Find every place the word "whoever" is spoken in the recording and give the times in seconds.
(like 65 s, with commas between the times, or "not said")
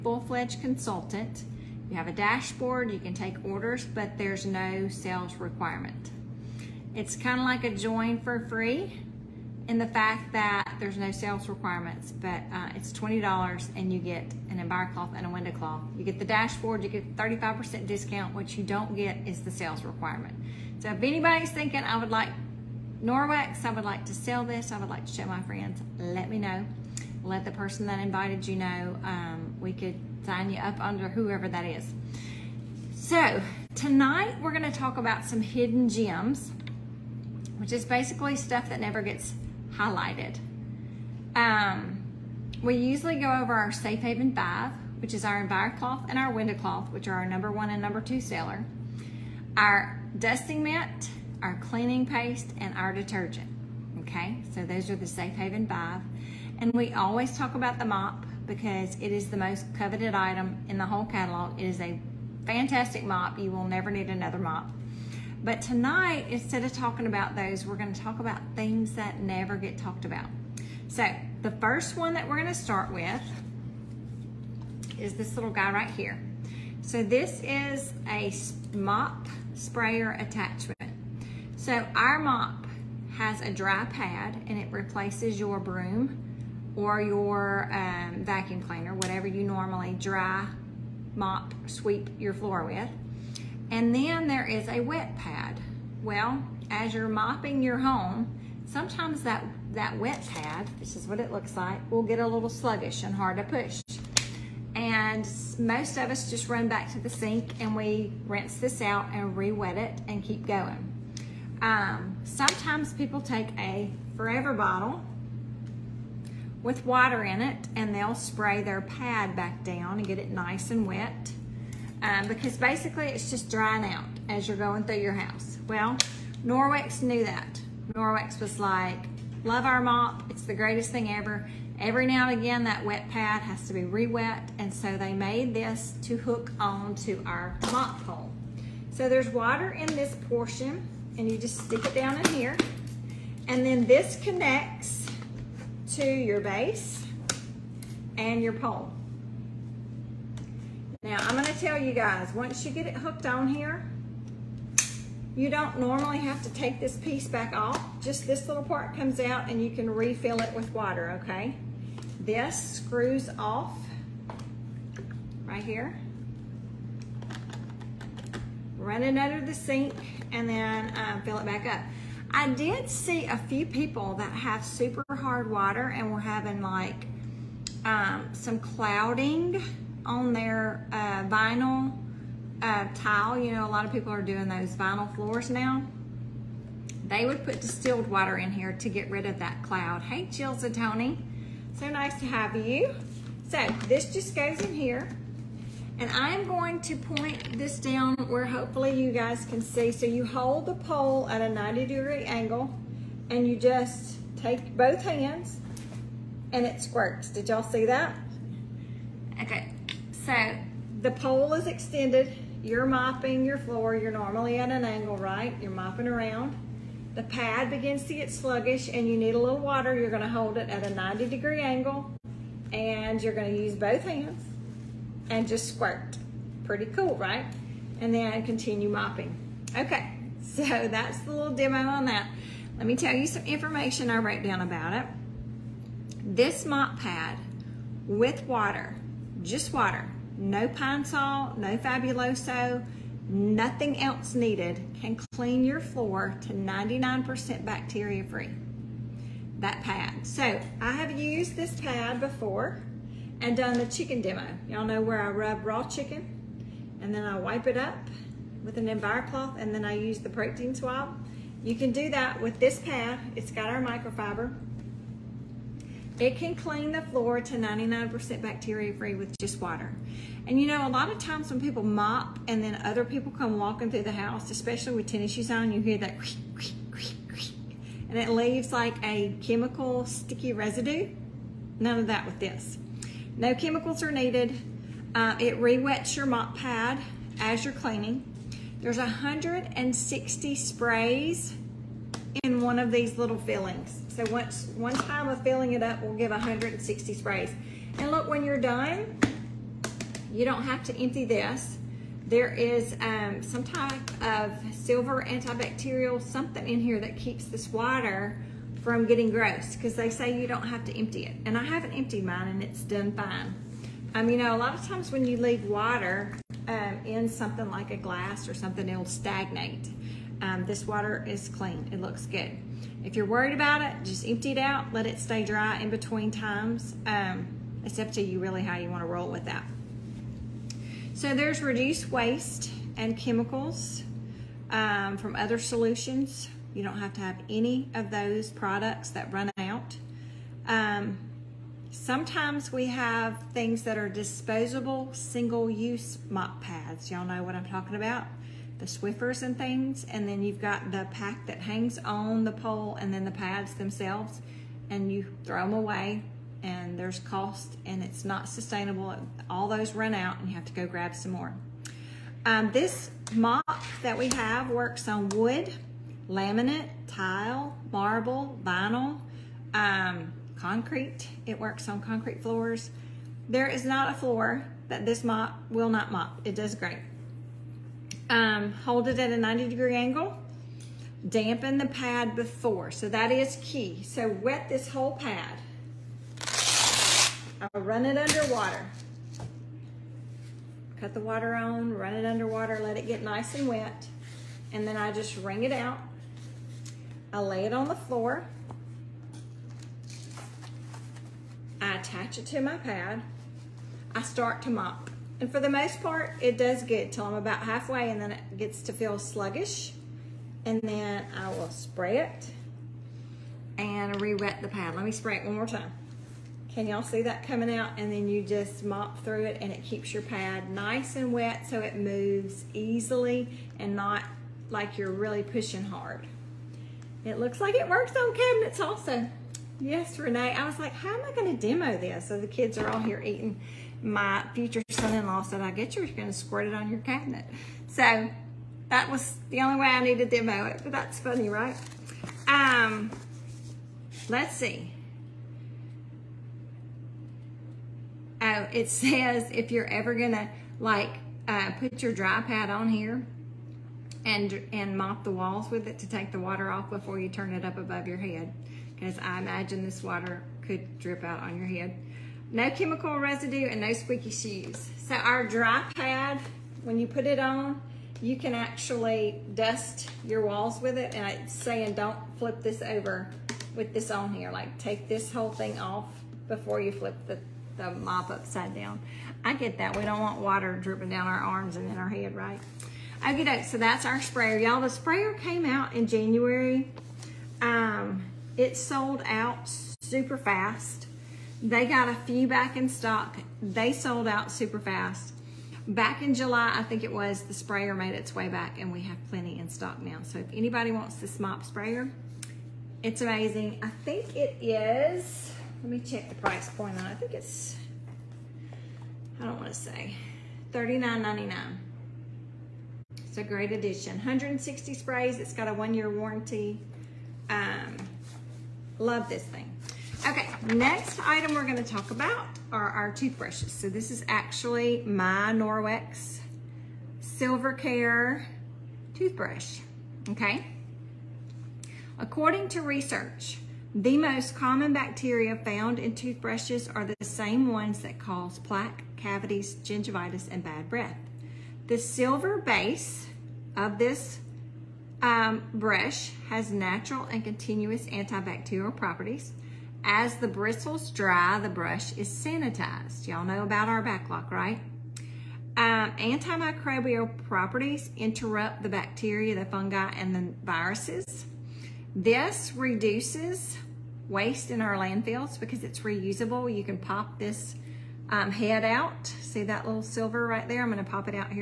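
31 s.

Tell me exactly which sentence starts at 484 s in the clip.
Y'all, the sprayer came out in January.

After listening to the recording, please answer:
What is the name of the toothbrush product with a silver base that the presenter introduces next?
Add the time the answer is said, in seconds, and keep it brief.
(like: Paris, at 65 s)
Norwex Silver Care, at 525 s.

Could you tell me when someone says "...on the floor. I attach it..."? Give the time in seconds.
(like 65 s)
397 s.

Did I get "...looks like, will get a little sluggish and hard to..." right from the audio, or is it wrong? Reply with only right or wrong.
right.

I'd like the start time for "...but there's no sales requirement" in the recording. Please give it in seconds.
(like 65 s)
3 s.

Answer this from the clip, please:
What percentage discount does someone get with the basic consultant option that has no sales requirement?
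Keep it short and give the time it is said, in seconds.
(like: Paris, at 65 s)
35%, at 17 s.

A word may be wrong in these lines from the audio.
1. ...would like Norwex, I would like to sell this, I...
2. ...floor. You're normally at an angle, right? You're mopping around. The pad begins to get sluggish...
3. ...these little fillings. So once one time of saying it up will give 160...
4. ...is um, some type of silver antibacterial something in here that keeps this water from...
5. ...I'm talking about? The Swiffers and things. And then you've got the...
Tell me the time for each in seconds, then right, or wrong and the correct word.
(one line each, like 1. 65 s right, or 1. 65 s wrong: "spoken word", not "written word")
1. 21 s right
2. 213 s right
3. 292 s wrong: "filling", not "saying"
4. 302 s right
5. 347 s right.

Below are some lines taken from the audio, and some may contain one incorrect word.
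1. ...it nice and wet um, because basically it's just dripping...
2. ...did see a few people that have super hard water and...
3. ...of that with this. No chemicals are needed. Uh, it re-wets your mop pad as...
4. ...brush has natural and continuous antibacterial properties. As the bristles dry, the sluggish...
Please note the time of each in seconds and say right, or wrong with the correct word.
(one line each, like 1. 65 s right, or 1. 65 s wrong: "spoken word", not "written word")
1. 120 s wrong: "drying", not "dripping"
2. 172 s right
3. 281 s right
4. 545 s wrong: "brush", not "sluggish".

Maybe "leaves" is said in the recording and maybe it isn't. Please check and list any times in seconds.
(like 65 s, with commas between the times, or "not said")
278 s, 315 s.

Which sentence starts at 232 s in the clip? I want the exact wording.
Let me tell you some information I wrote down about it.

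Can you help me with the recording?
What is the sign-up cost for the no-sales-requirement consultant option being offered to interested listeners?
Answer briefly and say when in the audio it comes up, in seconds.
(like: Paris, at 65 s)
$20, at 12 s.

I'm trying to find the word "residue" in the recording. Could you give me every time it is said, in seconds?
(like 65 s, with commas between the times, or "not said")
280 s, 463 s.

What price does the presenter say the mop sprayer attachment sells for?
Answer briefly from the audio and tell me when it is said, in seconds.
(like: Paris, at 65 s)
$39.99, at 510 s.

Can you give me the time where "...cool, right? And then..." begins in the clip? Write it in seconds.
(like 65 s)
226 s.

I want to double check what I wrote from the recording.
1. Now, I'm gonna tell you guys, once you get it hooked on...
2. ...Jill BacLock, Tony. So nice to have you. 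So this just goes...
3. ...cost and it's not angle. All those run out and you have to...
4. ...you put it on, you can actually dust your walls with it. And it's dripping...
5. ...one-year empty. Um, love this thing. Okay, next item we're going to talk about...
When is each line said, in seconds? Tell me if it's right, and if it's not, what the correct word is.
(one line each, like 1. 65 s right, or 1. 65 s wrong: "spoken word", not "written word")
1. 151 s right
2. 190 s wrong: "Zatoni", not "BacLock"
3. 357 s wrong: "sustainable", not "angle"
4. 466 s wrong: "saying", not "dripping"
5. 515 s wrong: "warranty", not "empty".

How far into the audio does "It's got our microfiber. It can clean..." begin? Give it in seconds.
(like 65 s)
263 s.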